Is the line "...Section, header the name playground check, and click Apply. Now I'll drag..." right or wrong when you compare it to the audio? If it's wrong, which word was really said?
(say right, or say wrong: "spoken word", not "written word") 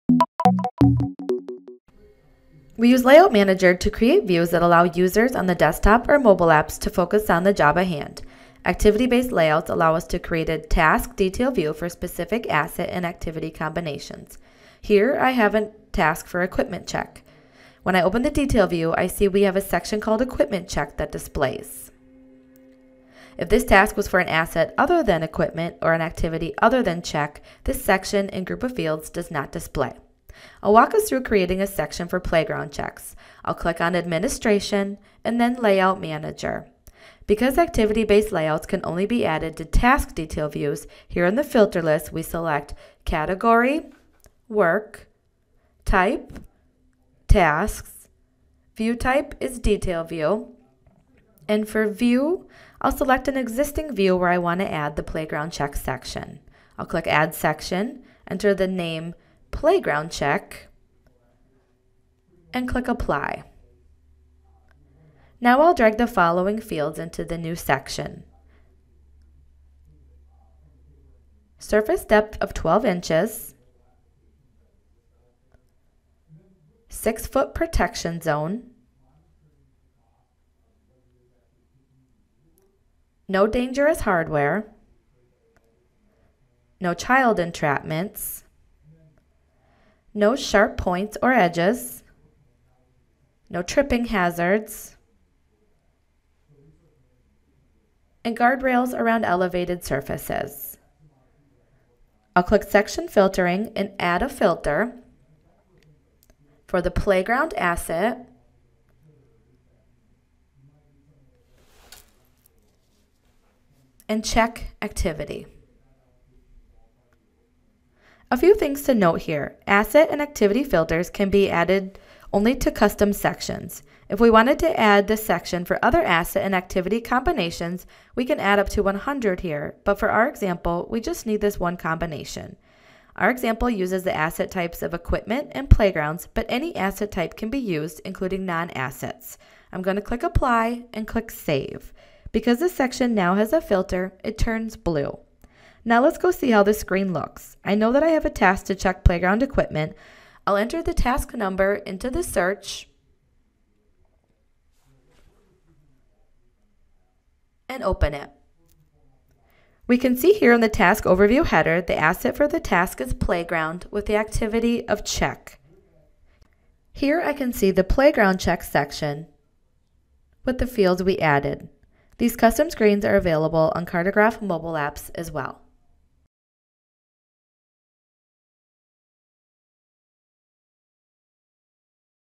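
wrong: "enter", not "header".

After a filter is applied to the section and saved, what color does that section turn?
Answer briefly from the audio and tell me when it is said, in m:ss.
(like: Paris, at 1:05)
Blue, at 2:24.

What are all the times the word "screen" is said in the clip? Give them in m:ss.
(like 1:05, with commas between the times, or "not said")
2:26, 2:52.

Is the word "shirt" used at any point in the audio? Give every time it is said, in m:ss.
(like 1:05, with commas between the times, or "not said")
not said.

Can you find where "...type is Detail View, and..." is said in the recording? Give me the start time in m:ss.
0:48.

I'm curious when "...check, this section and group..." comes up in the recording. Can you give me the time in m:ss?
0:27.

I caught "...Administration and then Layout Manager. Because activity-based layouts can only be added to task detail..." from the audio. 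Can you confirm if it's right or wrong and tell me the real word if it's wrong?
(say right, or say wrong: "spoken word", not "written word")
right.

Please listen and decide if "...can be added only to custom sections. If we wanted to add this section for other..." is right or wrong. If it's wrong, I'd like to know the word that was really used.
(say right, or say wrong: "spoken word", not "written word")
right.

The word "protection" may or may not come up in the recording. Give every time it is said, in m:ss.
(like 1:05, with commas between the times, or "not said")
1:17.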